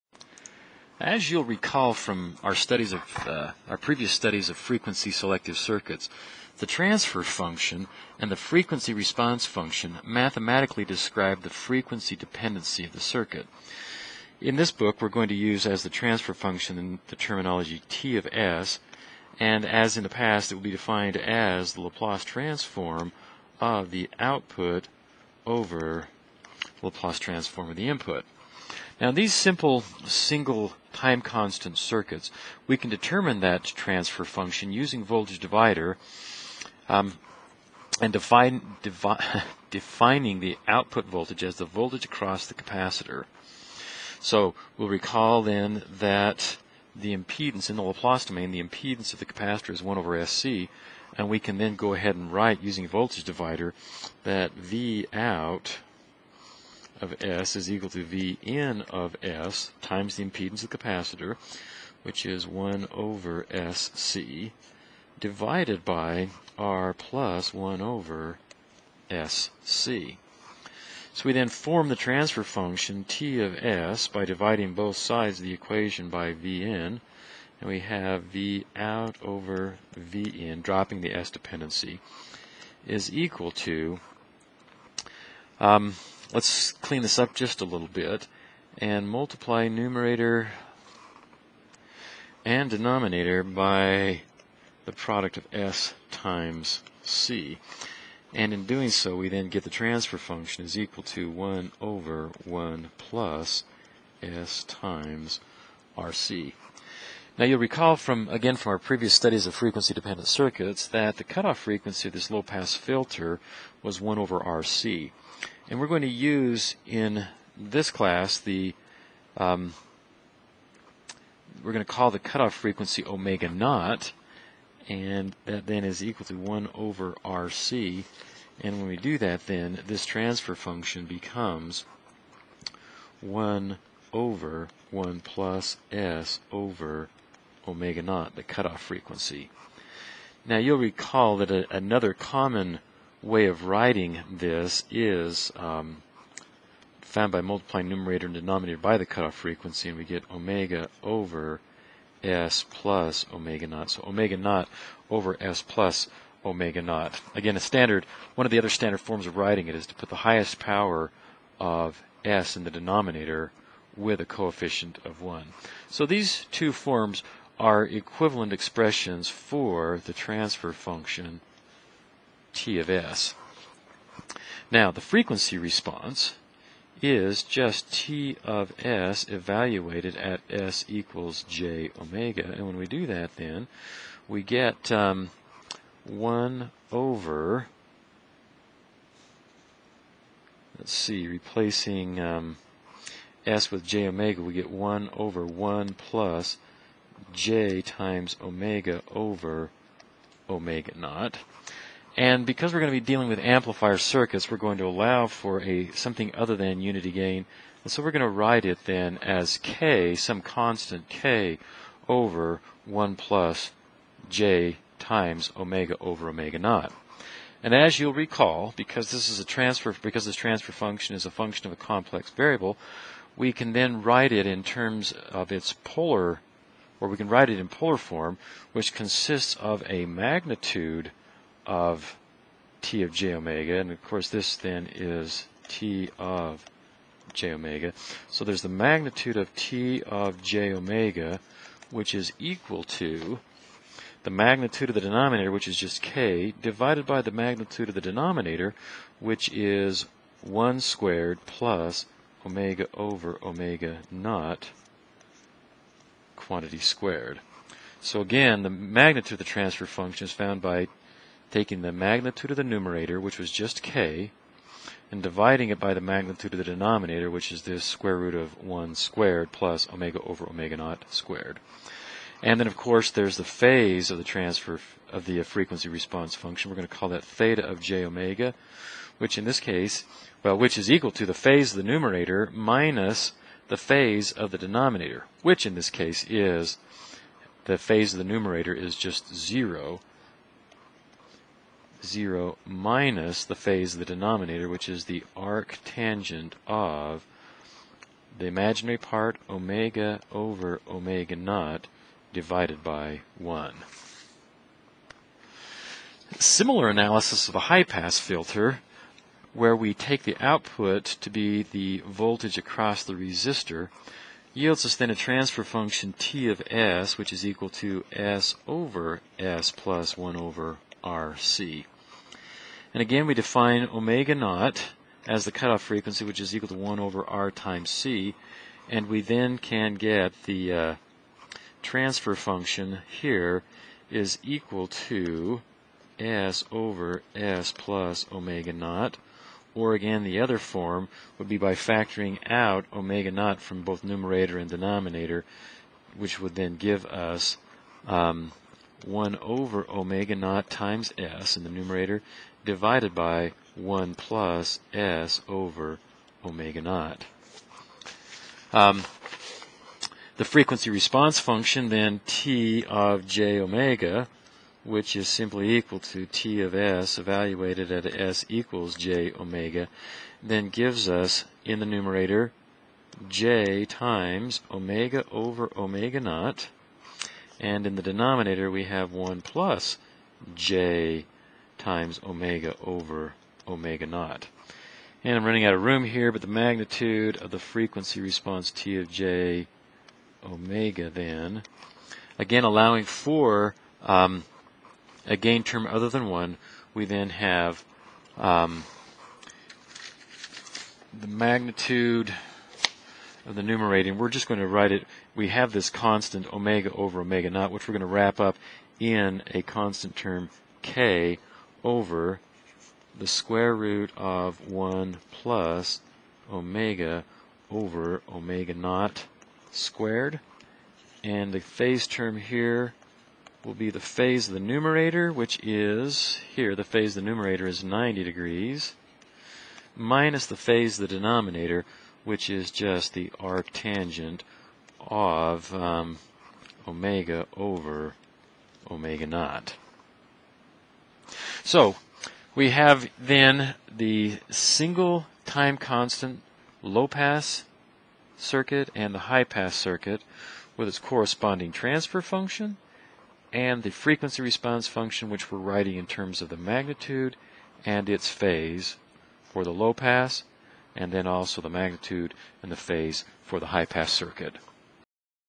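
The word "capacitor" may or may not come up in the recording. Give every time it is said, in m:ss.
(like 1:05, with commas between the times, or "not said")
0:42, 0:49, 1:00.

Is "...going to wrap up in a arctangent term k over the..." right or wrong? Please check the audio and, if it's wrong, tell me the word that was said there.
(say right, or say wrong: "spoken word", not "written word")
wrong: "constant", not "arctangent".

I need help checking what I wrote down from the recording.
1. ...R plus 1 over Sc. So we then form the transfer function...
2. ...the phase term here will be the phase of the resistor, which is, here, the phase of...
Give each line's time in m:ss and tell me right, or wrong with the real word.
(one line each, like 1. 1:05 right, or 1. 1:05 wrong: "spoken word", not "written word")
1. 1:06 right
2. 7:01 wrong: "numerator", not "resistor".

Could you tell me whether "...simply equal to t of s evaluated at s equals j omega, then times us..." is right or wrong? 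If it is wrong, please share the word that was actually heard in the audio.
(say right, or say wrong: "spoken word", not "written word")
wrong: "gives", not "times".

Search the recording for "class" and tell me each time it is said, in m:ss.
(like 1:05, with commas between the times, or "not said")
1:57.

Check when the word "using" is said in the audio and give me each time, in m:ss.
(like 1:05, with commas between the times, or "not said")
0:34, 0:52.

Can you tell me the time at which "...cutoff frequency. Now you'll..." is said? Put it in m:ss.
2:18.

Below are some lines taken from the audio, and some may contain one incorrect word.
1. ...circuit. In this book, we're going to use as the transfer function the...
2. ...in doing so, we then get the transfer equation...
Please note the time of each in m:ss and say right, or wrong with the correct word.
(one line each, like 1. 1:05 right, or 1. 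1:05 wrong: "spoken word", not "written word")
1. 0:12 right
2. 1:38 wrong: "function", not "equation".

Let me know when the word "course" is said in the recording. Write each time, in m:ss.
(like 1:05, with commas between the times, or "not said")
3:54, 4:32.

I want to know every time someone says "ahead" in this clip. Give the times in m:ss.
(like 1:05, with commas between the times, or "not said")
0:51.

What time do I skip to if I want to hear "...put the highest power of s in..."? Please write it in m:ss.
2:39.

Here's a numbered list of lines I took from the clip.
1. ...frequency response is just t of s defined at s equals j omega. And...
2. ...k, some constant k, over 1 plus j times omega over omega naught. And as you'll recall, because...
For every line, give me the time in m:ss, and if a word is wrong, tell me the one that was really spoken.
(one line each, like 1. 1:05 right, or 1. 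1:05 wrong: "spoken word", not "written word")
1. 2:55 wrong: "evaluated", not "defined"
2. 3:29 right.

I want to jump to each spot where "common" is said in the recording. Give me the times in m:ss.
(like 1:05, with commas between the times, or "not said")
2:22.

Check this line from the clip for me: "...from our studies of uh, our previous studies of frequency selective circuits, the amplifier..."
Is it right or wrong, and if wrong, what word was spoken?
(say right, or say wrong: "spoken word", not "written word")
wrong: "transfer", not "amplifier".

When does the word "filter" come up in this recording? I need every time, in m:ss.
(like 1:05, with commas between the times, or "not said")
1:52, 5:08.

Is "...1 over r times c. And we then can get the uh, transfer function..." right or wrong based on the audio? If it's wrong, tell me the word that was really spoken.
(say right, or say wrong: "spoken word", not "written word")
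right.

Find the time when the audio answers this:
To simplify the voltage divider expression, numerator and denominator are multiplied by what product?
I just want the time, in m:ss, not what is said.
1:34.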